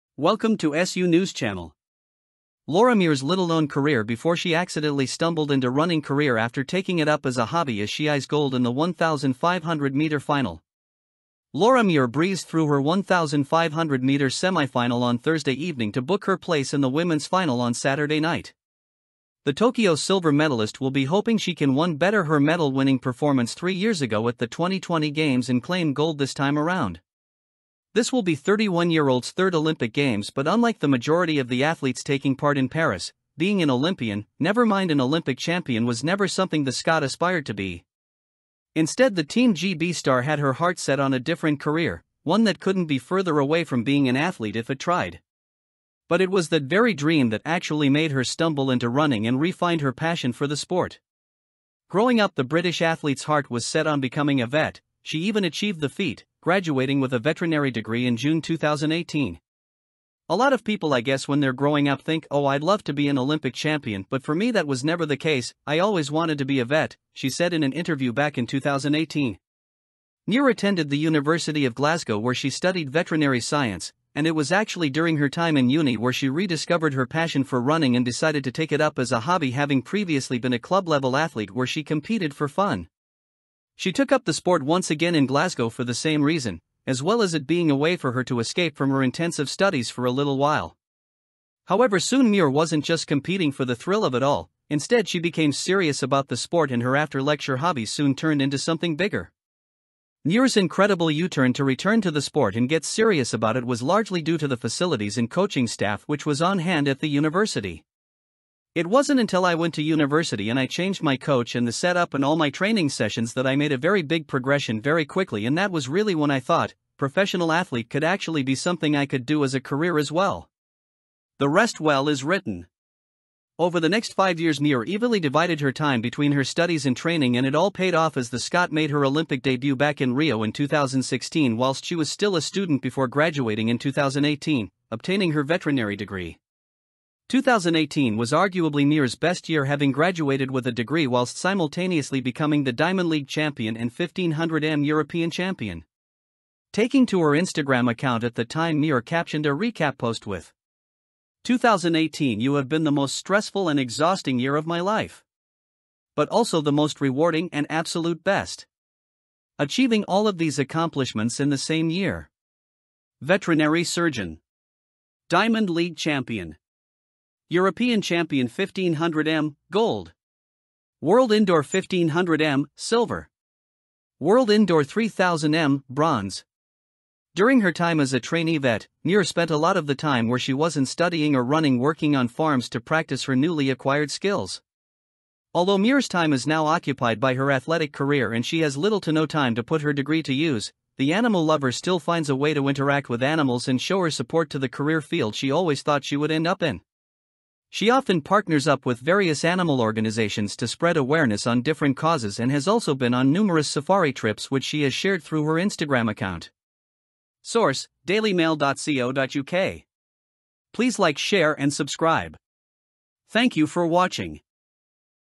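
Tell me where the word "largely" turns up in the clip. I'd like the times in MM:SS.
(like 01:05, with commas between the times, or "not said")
01:43.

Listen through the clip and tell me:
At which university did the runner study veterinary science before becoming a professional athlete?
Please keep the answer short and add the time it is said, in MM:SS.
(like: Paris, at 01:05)
University of Glasgow, at 01:10.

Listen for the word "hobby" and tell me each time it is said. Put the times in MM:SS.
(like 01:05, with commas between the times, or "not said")
00:07, 01:19, 01:37.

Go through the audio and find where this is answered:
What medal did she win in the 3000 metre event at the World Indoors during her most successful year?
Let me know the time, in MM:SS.
02:55.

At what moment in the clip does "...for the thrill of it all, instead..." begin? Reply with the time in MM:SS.
01:33.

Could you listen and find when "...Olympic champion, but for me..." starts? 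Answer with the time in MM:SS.
01:03.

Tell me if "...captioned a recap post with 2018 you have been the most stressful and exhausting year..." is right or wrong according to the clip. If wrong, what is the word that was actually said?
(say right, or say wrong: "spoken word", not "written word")
right.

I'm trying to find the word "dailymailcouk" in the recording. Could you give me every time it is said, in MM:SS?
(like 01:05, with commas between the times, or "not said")
03:28.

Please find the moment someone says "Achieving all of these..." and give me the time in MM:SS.
02:39.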